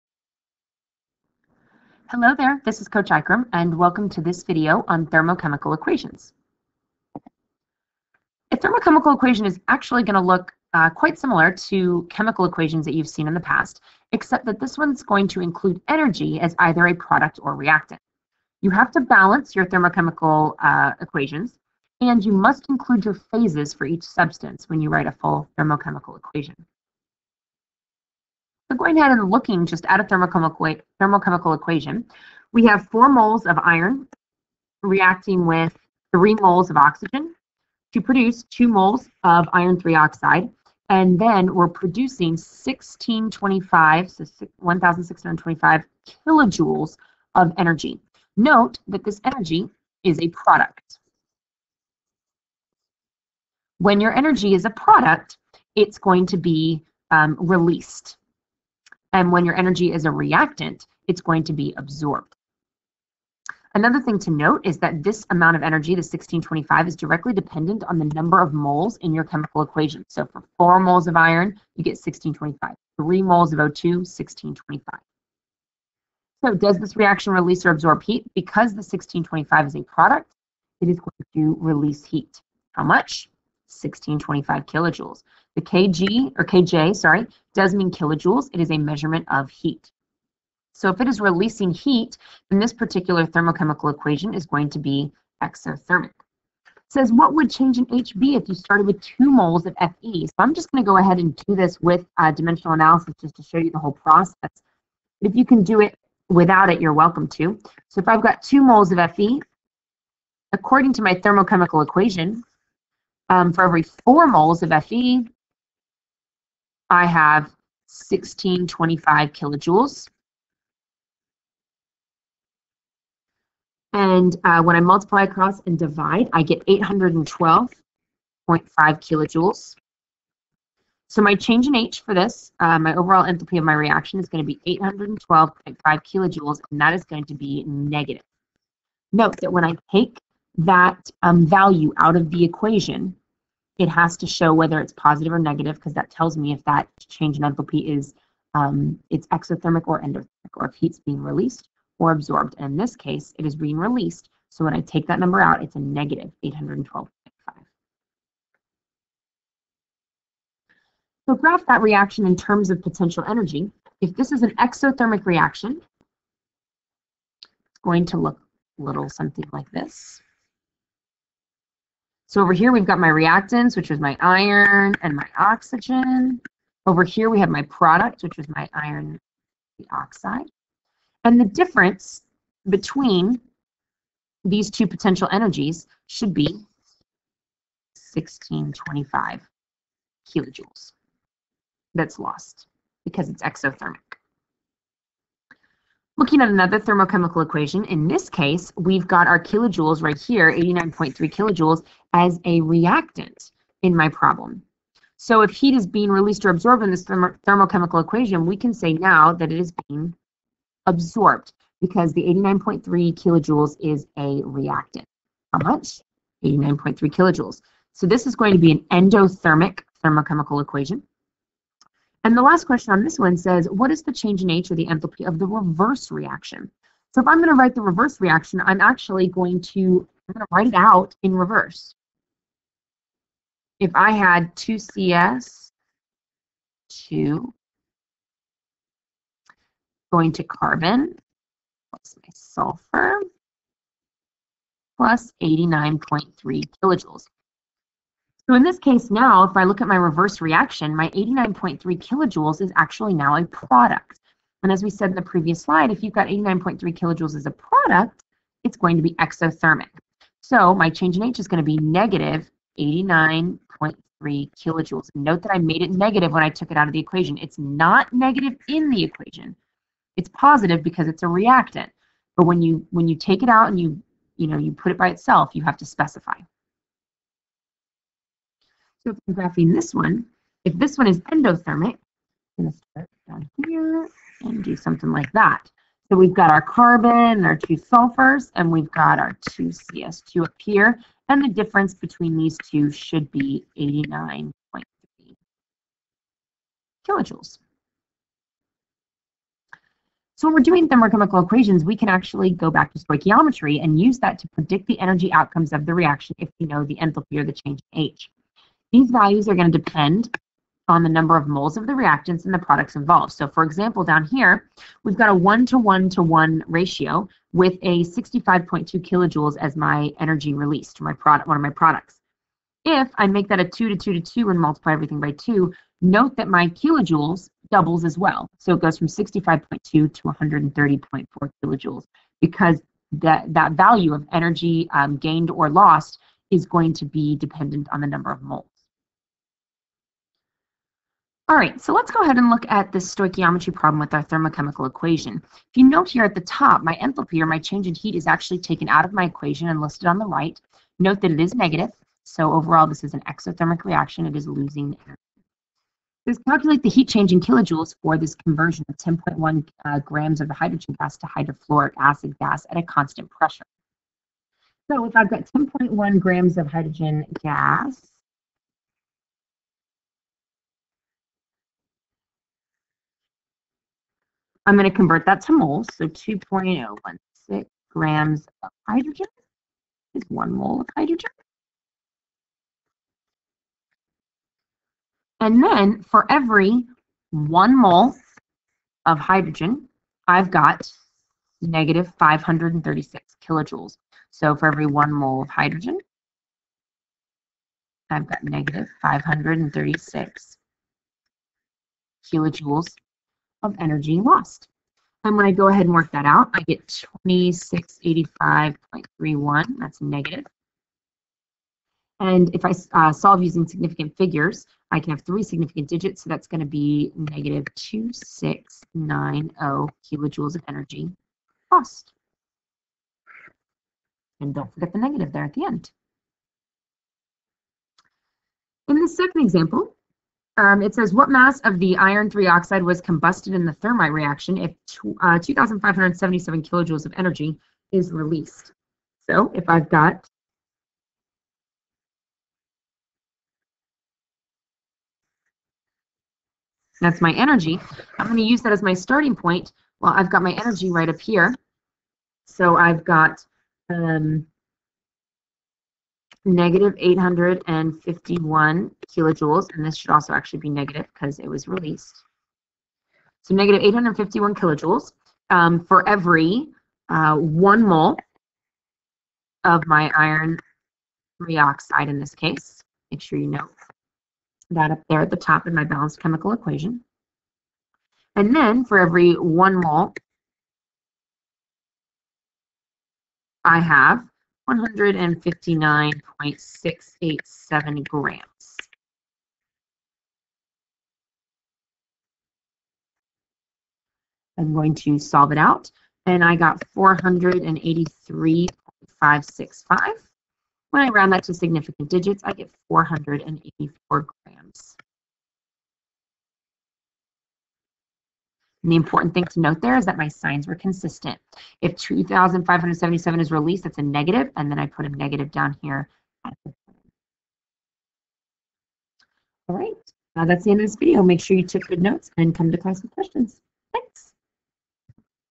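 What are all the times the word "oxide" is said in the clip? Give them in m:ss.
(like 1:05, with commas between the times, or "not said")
0:39, 2:59, 7:12, 7:51.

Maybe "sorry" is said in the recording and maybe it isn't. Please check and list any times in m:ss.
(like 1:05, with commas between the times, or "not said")
1:26.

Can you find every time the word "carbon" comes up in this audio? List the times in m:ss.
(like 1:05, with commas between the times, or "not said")
4:00, 4:46.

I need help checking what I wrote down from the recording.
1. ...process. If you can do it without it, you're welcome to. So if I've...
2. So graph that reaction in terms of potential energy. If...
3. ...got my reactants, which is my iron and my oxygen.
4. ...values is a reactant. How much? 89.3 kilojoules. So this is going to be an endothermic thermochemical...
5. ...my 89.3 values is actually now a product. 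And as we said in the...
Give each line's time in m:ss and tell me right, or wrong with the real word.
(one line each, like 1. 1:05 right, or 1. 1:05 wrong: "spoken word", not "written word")
1. 1:43 right
2. 2:41 right
3. 2:52 right
4. 3:33 wrong: "kilojoules", not "values"
5. 4:10 wrong: "kilojoules", not "values".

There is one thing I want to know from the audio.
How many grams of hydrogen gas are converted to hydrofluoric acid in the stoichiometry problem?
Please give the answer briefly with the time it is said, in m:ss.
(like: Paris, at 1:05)
10.1 grams, at 5:58.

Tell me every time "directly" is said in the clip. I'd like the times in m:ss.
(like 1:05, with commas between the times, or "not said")
1:06.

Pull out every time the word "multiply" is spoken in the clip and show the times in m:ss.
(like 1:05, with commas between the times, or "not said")
2:04, 5:24.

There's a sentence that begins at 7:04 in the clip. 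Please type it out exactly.
And don't forget the negative there at the end.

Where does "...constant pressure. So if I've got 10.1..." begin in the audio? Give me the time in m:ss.
6:02.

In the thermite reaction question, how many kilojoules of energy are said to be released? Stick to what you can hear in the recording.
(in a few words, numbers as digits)
2,577 kilojoules.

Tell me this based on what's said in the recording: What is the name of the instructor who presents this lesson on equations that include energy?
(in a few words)
Coach Ikram.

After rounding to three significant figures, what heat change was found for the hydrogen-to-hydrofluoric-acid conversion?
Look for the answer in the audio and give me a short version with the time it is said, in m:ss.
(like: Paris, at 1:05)
-2690 kilojoules, at 6:57.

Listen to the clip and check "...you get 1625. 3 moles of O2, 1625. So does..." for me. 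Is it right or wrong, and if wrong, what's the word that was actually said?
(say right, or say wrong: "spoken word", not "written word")
right.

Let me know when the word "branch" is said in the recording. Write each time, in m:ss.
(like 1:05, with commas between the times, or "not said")
not said.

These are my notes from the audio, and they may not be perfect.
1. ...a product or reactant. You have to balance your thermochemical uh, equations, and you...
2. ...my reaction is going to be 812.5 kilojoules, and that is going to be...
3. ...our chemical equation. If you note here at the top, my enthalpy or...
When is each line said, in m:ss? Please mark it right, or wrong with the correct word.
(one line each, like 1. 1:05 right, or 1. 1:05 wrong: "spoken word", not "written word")
1. 0:16 right
2. 2:13 right
3. 5:44 wrong: "thermochemical", not "chemical".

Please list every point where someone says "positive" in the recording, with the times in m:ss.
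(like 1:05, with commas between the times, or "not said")
2:24, 4:30.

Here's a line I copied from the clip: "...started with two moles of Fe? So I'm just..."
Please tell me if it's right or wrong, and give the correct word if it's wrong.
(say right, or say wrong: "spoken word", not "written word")
right.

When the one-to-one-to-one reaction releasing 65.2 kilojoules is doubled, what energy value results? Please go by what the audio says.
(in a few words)
130.4 kilojoules.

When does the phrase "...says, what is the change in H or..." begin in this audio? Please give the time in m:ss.
3:43.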